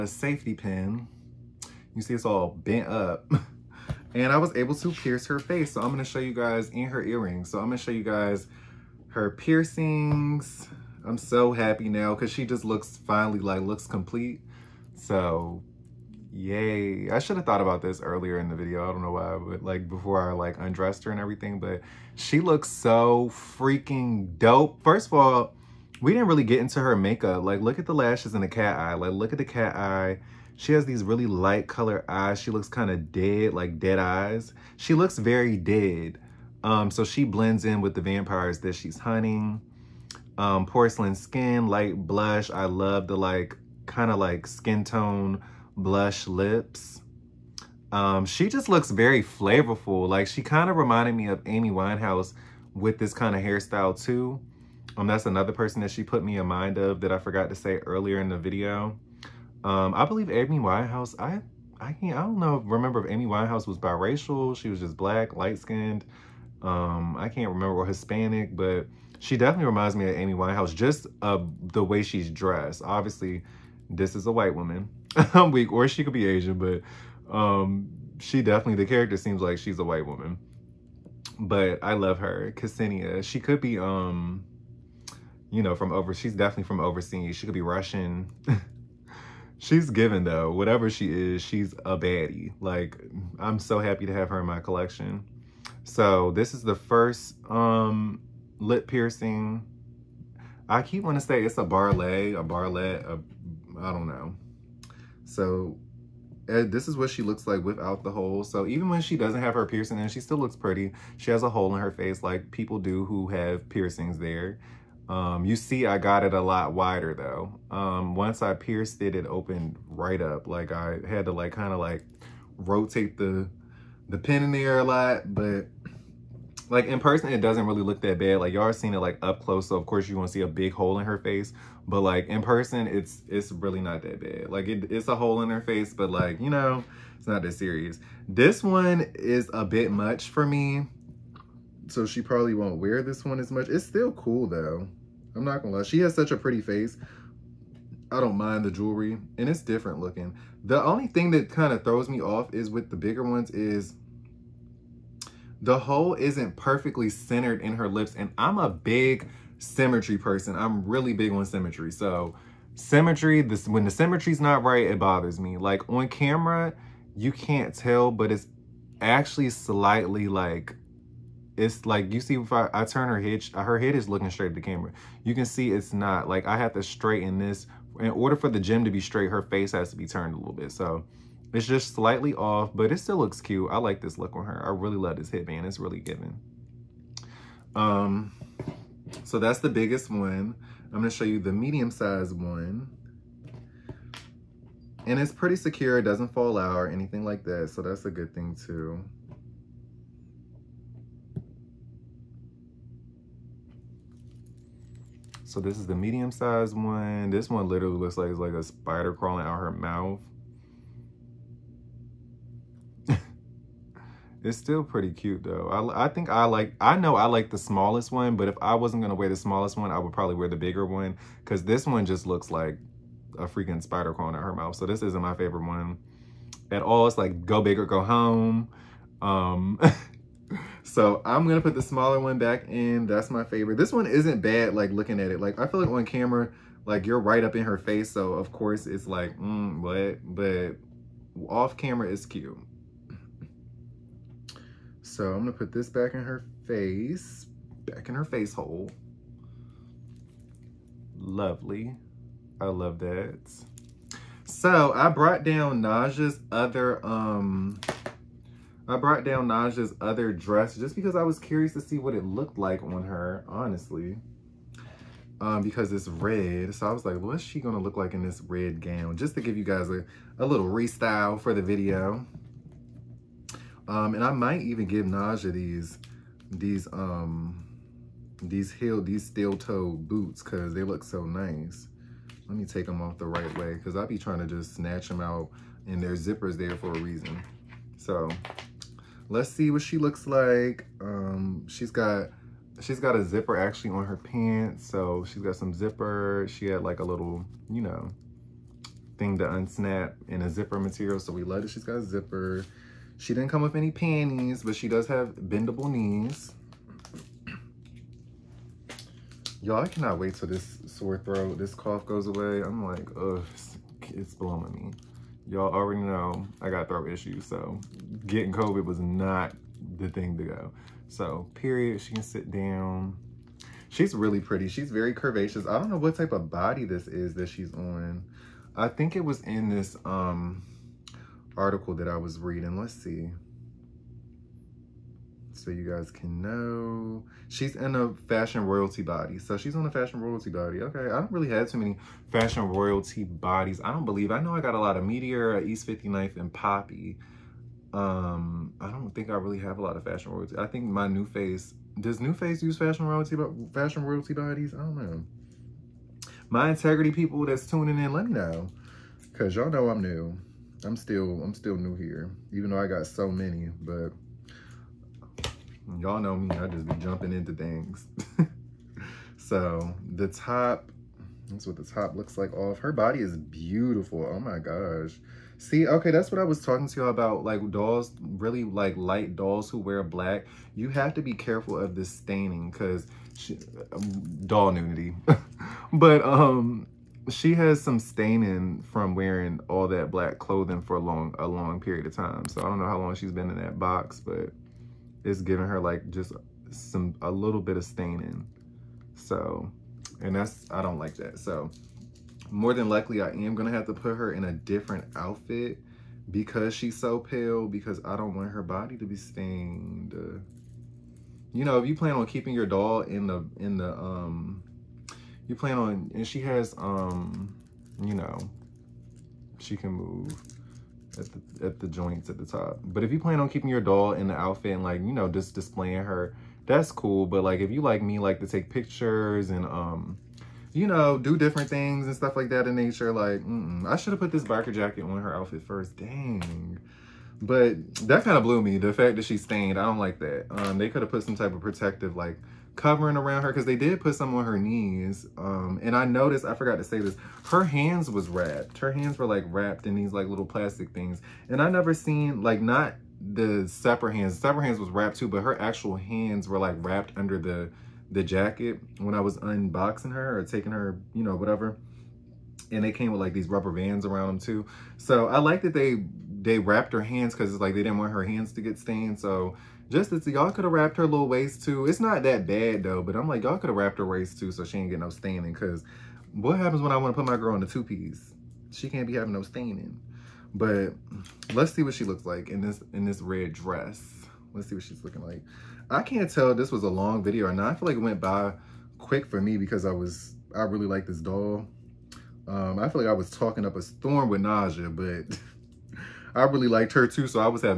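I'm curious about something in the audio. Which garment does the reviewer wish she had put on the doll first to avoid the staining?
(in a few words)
biker jacket.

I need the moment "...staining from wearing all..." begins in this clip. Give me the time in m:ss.
6:27.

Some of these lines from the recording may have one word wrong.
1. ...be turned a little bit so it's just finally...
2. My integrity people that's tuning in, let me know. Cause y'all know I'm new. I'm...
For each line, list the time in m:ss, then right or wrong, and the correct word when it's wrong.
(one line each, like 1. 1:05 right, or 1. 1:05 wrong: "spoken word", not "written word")
1. 2:59 wrong: "slightly", not "finally"
2. 5:56 right.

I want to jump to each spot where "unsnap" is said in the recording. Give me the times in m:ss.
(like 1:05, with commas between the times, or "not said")
4:59.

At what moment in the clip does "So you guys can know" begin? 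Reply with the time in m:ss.
5:35.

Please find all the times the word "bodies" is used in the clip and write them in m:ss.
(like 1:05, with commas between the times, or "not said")
5:43, 5:54.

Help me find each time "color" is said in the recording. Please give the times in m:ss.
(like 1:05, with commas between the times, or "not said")
0:31.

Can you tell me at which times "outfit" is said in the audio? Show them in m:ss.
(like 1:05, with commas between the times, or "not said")
6:45, 7:04, 7:15.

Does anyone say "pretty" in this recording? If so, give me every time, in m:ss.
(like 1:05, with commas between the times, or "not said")
1:50, 2:26, 3:15, 3:34, 5:24.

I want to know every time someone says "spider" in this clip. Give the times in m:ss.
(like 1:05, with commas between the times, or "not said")
3:28, 3:43.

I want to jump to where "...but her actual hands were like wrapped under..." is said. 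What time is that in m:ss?
7:35.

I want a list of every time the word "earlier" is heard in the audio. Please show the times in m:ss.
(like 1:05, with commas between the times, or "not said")
0:17, 0:57.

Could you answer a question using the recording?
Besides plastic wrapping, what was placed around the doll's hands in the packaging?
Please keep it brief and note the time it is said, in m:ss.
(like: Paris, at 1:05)
rubber bands, at 7:43.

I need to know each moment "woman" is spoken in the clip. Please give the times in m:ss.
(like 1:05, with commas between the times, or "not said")
1:14, 1:20.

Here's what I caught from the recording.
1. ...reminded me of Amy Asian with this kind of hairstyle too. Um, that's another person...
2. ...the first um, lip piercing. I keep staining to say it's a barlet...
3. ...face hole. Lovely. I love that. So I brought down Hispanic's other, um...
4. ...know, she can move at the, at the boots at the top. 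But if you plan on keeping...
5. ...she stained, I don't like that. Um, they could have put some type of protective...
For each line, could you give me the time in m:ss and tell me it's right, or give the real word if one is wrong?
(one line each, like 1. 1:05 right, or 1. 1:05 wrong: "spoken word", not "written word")
1. 0:50 wrong: "Winehouse", not "Asian"
2. 1:36 wrong: "wanting", not "staining"
3. 4:08 wrong: "Naja", not "Hispanic"
4. 6:58 wrong: "joints", not "boots"
5. 7:19 right.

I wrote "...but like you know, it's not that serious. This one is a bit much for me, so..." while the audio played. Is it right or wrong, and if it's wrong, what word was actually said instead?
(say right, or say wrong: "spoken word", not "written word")
right.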